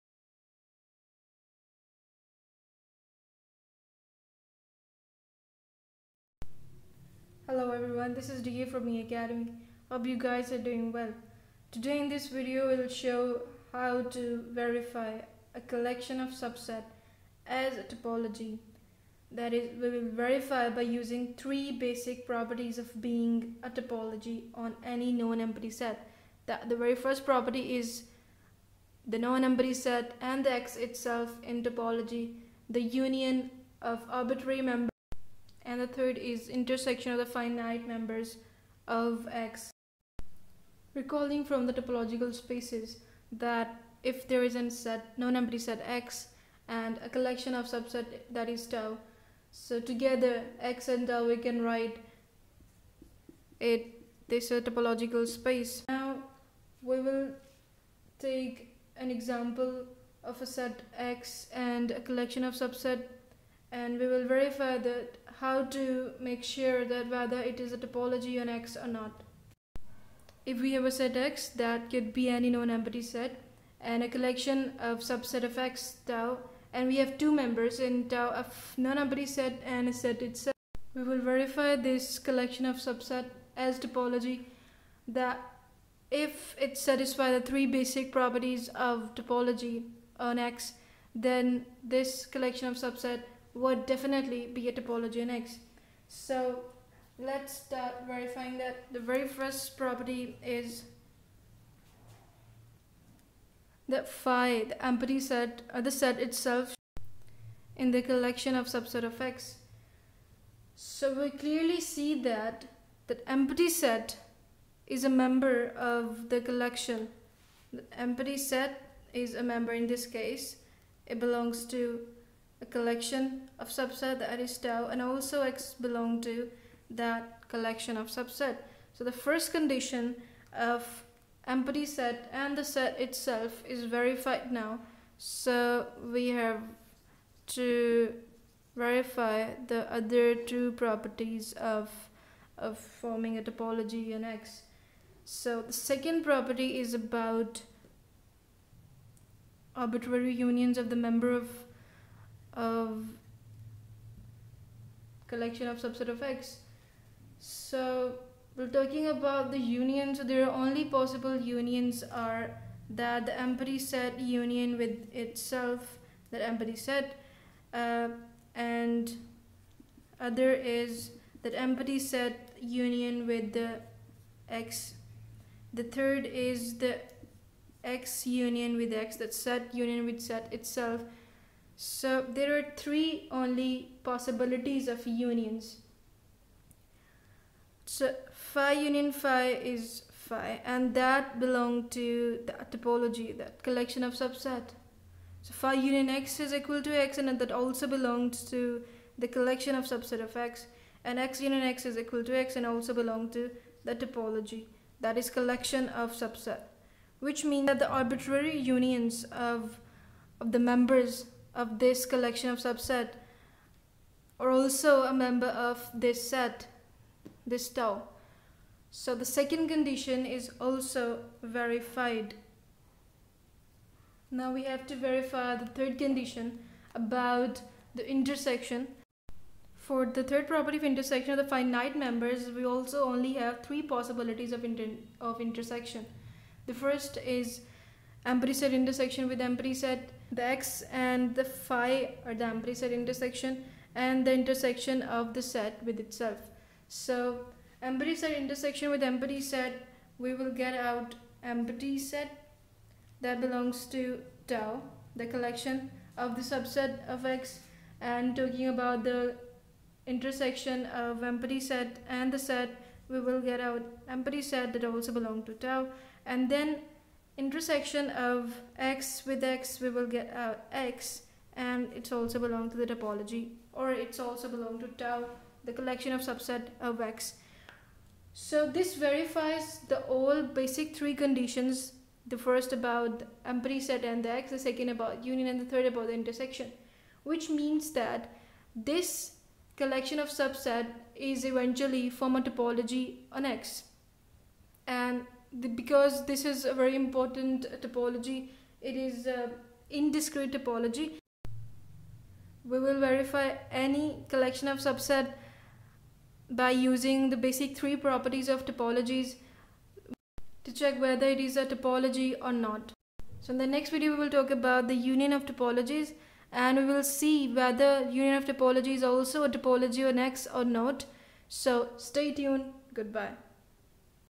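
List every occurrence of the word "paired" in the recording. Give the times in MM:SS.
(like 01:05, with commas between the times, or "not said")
not said.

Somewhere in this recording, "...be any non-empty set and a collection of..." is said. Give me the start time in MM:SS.
01:12.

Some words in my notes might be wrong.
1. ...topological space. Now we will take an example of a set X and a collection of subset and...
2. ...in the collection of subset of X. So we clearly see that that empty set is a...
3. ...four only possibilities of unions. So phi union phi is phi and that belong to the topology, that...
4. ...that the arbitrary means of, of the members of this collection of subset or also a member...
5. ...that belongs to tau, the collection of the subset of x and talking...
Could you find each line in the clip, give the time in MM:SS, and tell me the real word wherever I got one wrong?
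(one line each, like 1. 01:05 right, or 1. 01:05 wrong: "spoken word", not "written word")
1. 00:54 right
2. 01:47 right
3. 03:02 wrong: "three", not "four"
4. 03:27 wrong: "unions", not "means"
5. 04:13 right.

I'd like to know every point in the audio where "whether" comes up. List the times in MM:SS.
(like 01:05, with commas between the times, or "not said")
01:07, 05:11, 05:17.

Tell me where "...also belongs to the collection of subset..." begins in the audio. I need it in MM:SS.
03:17.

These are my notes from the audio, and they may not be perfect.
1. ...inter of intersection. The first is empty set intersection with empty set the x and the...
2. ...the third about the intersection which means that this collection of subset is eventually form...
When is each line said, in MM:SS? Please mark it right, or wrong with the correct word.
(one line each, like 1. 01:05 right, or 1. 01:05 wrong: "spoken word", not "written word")
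1. 03:54 right
2. 04:45 right.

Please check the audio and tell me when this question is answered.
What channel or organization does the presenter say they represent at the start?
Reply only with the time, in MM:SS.
00:08.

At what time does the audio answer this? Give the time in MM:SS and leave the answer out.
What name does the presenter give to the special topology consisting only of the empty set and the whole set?
04:59.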